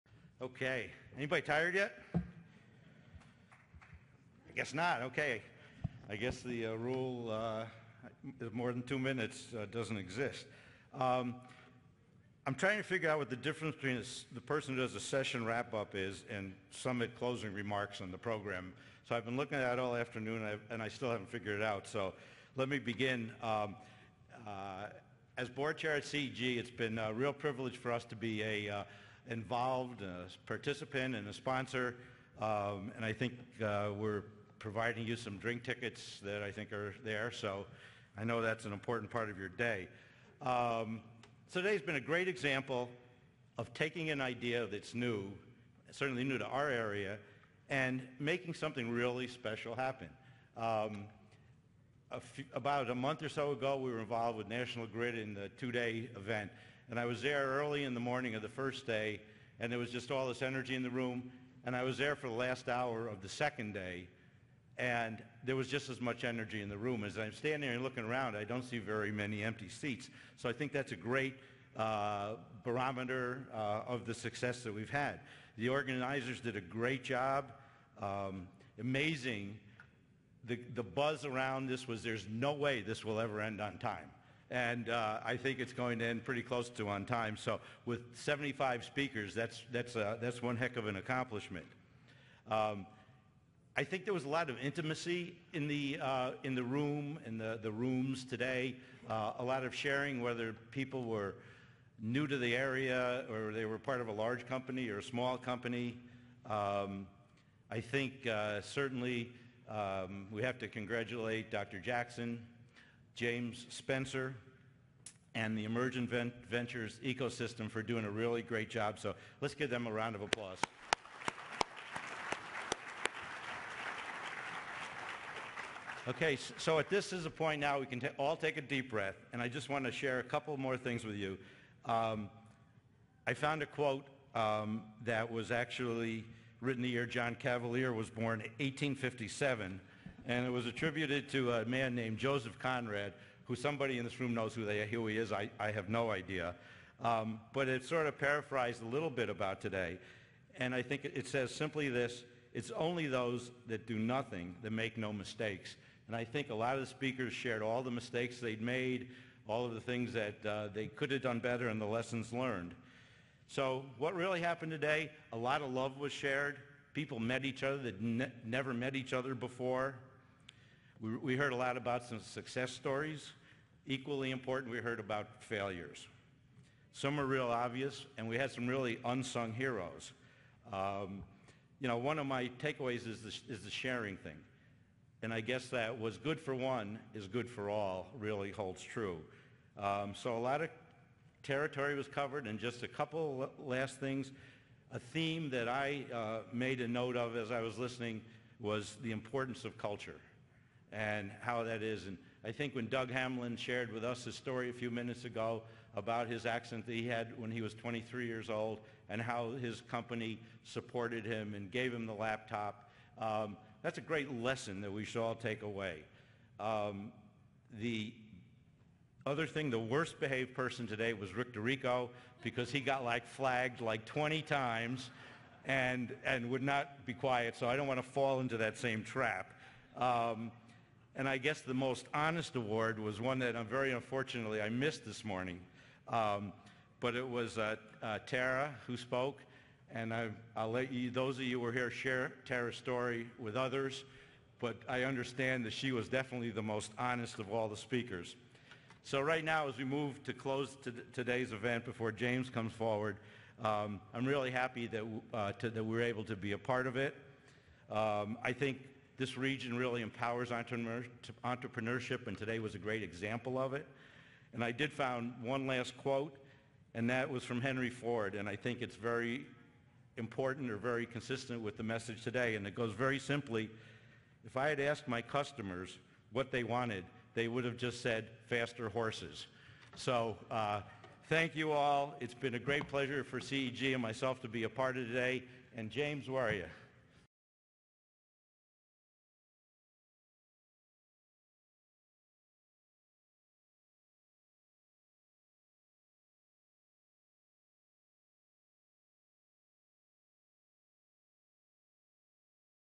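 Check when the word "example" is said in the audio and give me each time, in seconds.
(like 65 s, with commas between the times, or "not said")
42 s, 263 s.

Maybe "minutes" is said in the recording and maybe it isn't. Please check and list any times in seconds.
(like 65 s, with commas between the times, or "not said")
8 s, 204 s.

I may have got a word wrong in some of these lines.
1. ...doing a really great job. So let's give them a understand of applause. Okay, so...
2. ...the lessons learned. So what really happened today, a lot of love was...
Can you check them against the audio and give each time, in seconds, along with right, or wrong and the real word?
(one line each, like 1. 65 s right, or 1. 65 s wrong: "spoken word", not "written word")
1. 117 s wrong: "round", not "understand"
2. 161 s right.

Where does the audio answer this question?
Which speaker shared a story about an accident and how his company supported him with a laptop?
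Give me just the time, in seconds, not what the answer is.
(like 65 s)
202 s.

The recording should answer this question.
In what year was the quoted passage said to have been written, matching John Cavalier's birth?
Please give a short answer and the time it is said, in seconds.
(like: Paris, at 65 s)
1857, at 138 s.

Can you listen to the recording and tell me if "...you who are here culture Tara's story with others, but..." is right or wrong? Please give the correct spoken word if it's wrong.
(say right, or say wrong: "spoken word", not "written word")
wrong: "share", not "culture".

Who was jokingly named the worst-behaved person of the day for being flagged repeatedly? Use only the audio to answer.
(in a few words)
Rick DeRico.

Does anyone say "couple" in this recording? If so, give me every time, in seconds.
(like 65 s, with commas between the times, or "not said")
130 s, 192 s.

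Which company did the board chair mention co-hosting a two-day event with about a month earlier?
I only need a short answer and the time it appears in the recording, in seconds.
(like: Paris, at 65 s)
National Grid, at 54 s.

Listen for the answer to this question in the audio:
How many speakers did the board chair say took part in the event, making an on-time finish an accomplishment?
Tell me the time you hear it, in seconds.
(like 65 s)
88 s.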